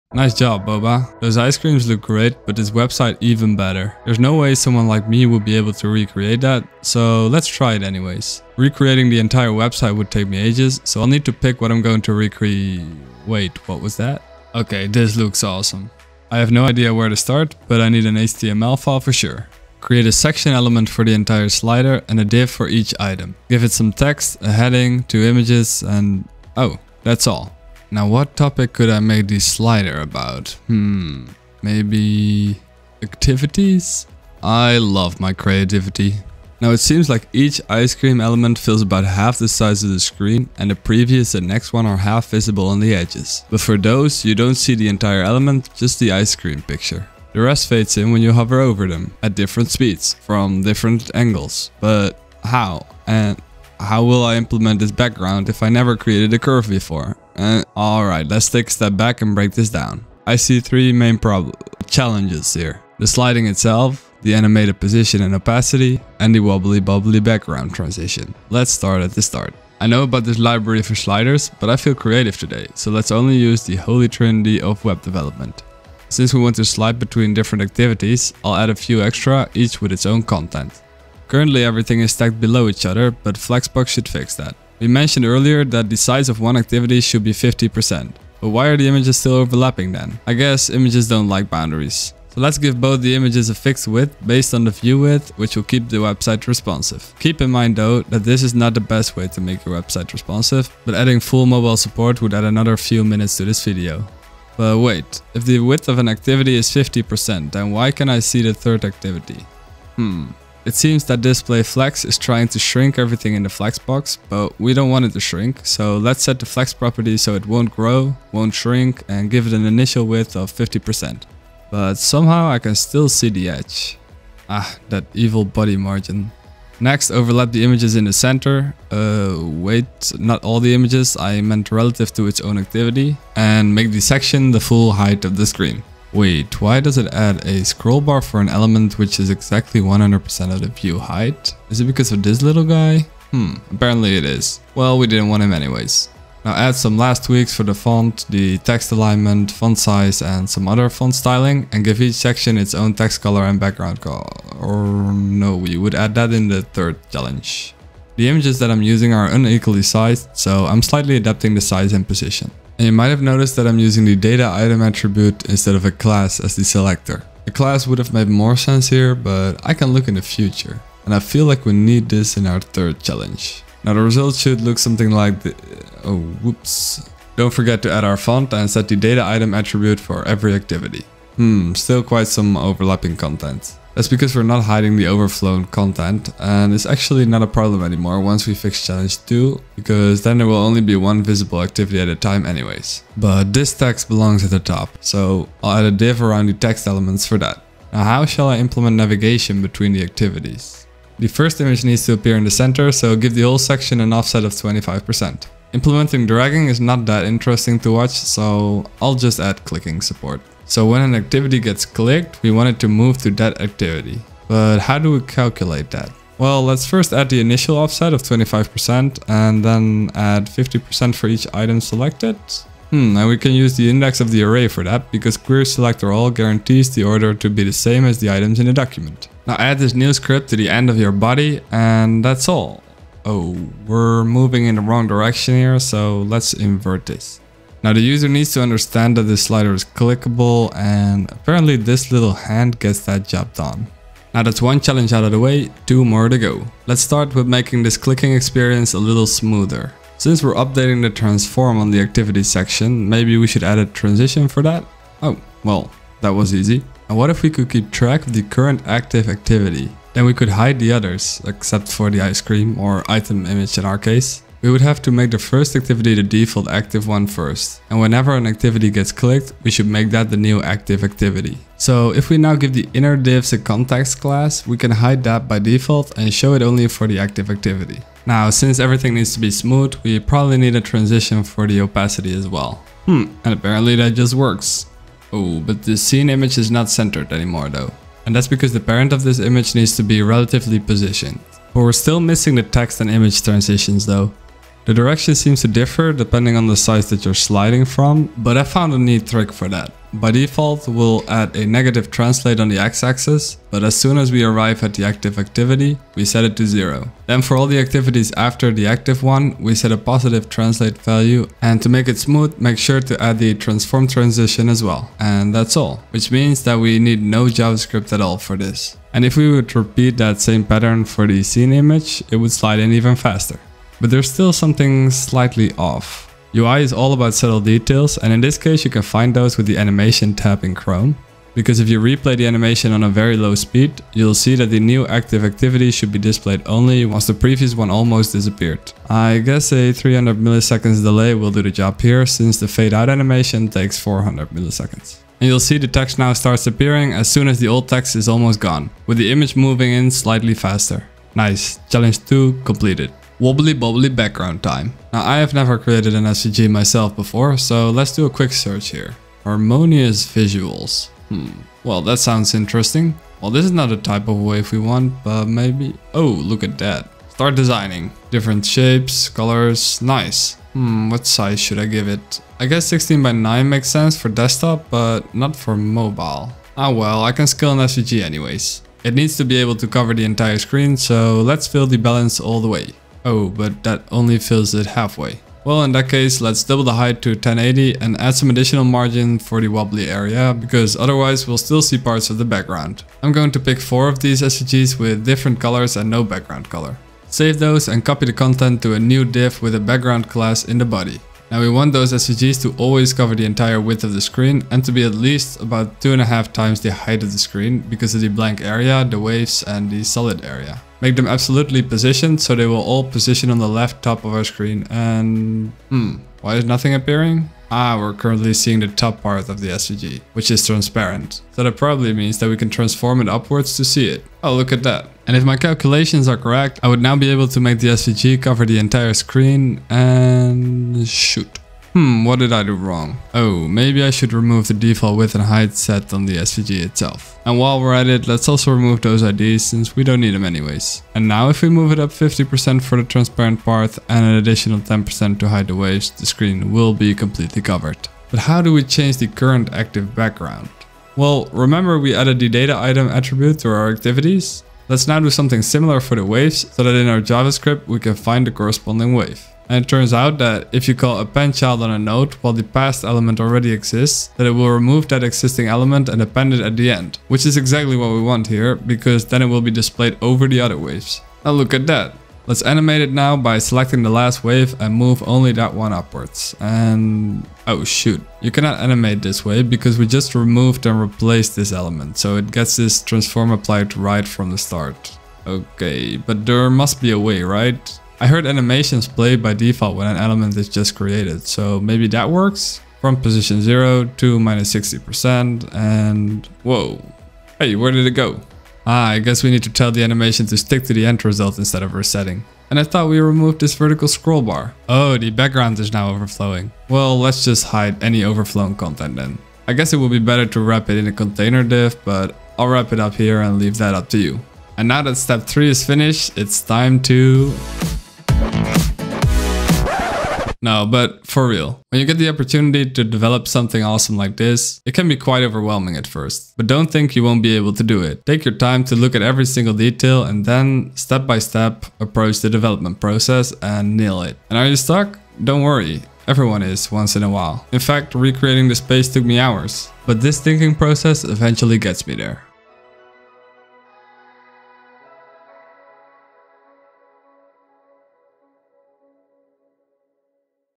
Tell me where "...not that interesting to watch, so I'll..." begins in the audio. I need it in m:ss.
3:26.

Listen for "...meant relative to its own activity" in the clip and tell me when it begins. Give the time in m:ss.
2:11.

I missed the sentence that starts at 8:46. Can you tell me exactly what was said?
But don't think you won't be able to do it.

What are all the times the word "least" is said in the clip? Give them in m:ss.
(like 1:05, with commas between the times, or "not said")
6:45.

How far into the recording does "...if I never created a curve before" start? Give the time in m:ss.
0:55.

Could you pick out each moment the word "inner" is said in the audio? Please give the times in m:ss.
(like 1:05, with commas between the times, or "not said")
4:32.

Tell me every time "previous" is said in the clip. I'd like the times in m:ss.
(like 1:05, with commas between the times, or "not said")
0:40, 5:37.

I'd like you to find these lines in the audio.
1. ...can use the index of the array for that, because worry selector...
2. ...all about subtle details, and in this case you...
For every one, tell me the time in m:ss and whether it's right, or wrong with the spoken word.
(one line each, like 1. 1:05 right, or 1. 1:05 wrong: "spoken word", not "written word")
1. 3:43 wrong: "query", not "worry"
2. 5:26 right.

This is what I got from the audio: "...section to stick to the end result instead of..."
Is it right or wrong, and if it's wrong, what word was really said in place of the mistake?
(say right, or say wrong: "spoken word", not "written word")
wrong: "animation", not "section".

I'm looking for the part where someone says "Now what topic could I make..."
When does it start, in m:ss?
0:27.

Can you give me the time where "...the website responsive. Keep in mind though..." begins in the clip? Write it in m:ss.
1:35.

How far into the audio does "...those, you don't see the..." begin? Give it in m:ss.
0:43.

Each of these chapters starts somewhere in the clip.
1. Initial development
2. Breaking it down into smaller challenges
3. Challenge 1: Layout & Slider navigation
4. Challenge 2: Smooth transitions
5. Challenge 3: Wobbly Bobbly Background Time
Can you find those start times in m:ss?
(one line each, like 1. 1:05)
1. 0:17
2. 0:57
3. 1:08
4. 4:06
5. 5:53.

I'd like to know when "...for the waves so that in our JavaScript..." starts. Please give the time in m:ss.
7:35.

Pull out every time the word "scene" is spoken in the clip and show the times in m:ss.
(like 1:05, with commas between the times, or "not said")
4:45, 5:21.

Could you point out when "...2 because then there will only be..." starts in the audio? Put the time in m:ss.
3:09.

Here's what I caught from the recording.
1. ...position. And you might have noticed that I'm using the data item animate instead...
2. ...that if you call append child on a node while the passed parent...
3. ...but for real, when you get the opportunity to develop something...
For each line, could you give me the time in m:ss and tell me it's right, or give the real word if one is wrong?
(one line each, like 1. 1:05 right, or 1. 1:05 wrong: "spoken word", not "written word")
1. 2:42 wrong: "attribute", not "animate"
2. 7:40 wrong: "element", not "parent"
3. 8:40 right.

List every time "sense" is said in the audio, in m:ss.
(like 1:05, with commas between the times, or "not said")
2:48, 6:13.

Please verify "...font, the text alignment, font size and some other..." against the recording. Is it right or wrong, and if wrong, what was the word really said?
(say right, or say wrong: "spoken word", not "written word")
right.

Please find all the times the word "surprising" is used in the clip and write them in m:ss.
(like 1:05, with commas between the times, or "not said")
not said.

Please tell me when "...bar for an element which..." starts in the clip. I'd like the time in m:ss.
2:18.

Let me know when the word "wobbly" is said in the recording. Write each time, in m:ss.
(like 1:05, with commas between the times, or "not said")
1:06, 5:53, 6:29.